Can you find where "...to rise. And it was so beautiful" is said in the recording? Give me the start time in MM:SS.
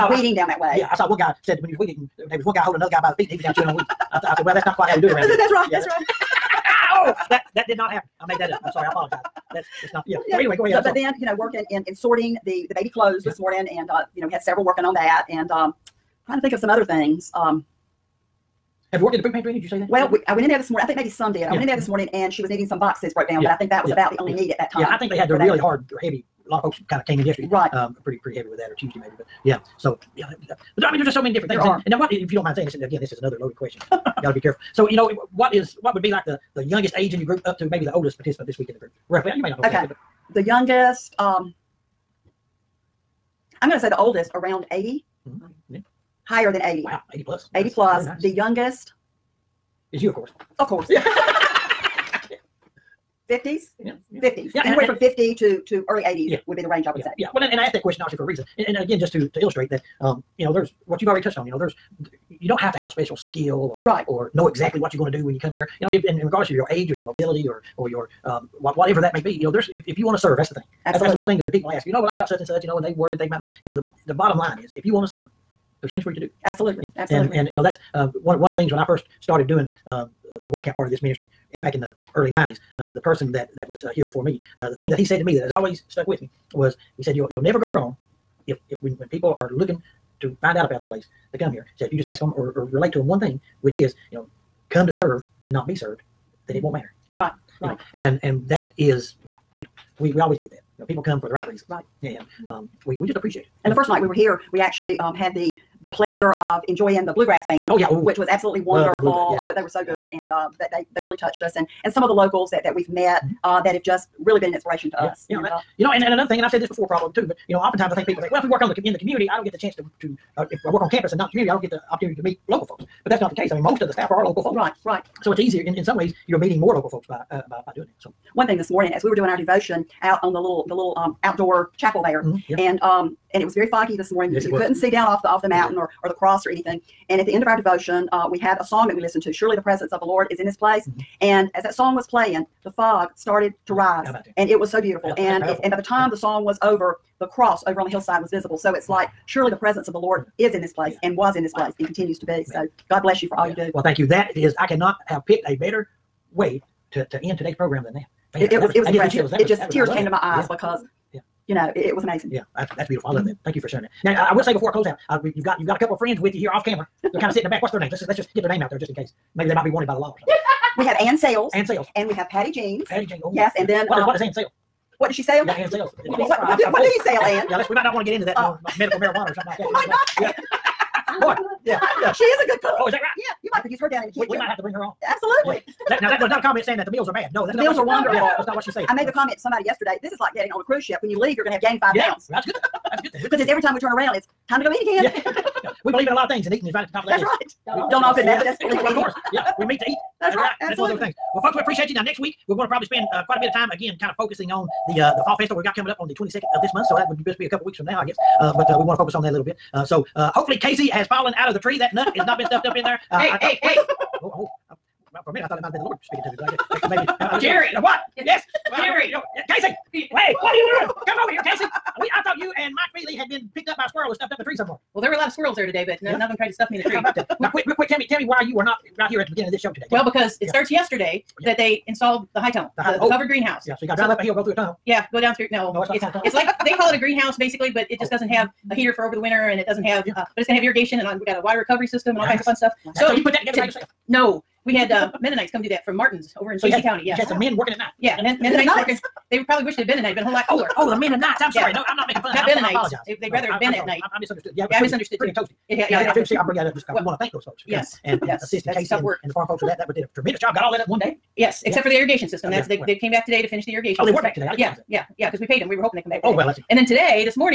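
02:23.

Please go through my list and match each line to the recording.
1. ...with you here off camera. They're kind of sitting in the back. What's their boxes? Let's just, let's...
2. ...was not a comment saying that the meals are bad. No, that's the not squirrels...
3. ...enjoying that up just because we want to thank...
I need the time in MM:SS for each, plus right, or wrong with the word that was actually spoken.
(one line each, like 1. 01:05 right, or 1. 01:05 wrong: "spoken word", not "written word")
1. 02:46 wrong: "names", not "boxes"
2. 03:06 wrong: "meals", not "squirrels"
3. 04:16 wrong: "bring", not "enjoying".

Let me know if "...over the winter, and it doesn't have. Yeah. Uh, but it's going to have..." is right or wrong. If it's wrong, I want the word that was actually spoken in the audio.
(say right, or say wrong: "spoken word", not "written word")
right.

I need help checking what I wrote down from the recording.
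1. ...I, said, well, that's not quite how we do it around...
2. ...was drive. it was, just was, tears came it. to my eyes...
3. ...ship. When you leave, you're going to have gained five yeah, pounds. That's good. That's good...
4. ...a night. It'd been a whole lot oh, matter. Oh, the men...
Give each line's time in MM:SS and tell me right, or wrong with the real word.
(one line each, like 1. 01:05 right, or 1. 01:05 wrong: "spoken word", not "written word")
1. 00:04 right
2. 02:38 wrong: "impressive", not "drive"
3. 03:10 right
4. 04:09 wrong: "cooler", not "matter".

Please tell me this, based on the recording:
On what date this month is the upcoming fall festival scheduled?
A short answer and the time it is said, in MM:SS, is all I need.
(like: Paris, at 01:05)
the 22nd, at 03:26.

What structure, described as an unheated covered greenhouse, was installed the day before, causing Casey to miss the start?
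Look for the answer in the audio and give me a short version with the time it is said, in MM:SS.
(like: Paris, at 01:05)
high tunnel, at 03:52.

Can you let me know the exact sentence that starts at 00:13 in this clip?
this morning, and uh, you know, we had several working on that, and um, trying to think of some other things.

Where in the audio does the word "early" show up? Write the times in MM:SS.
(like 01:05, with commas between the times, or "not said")
00:55, 01:22.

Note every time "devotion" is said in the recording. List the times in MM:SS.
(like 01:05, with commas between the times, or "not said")
02:09, 02:17.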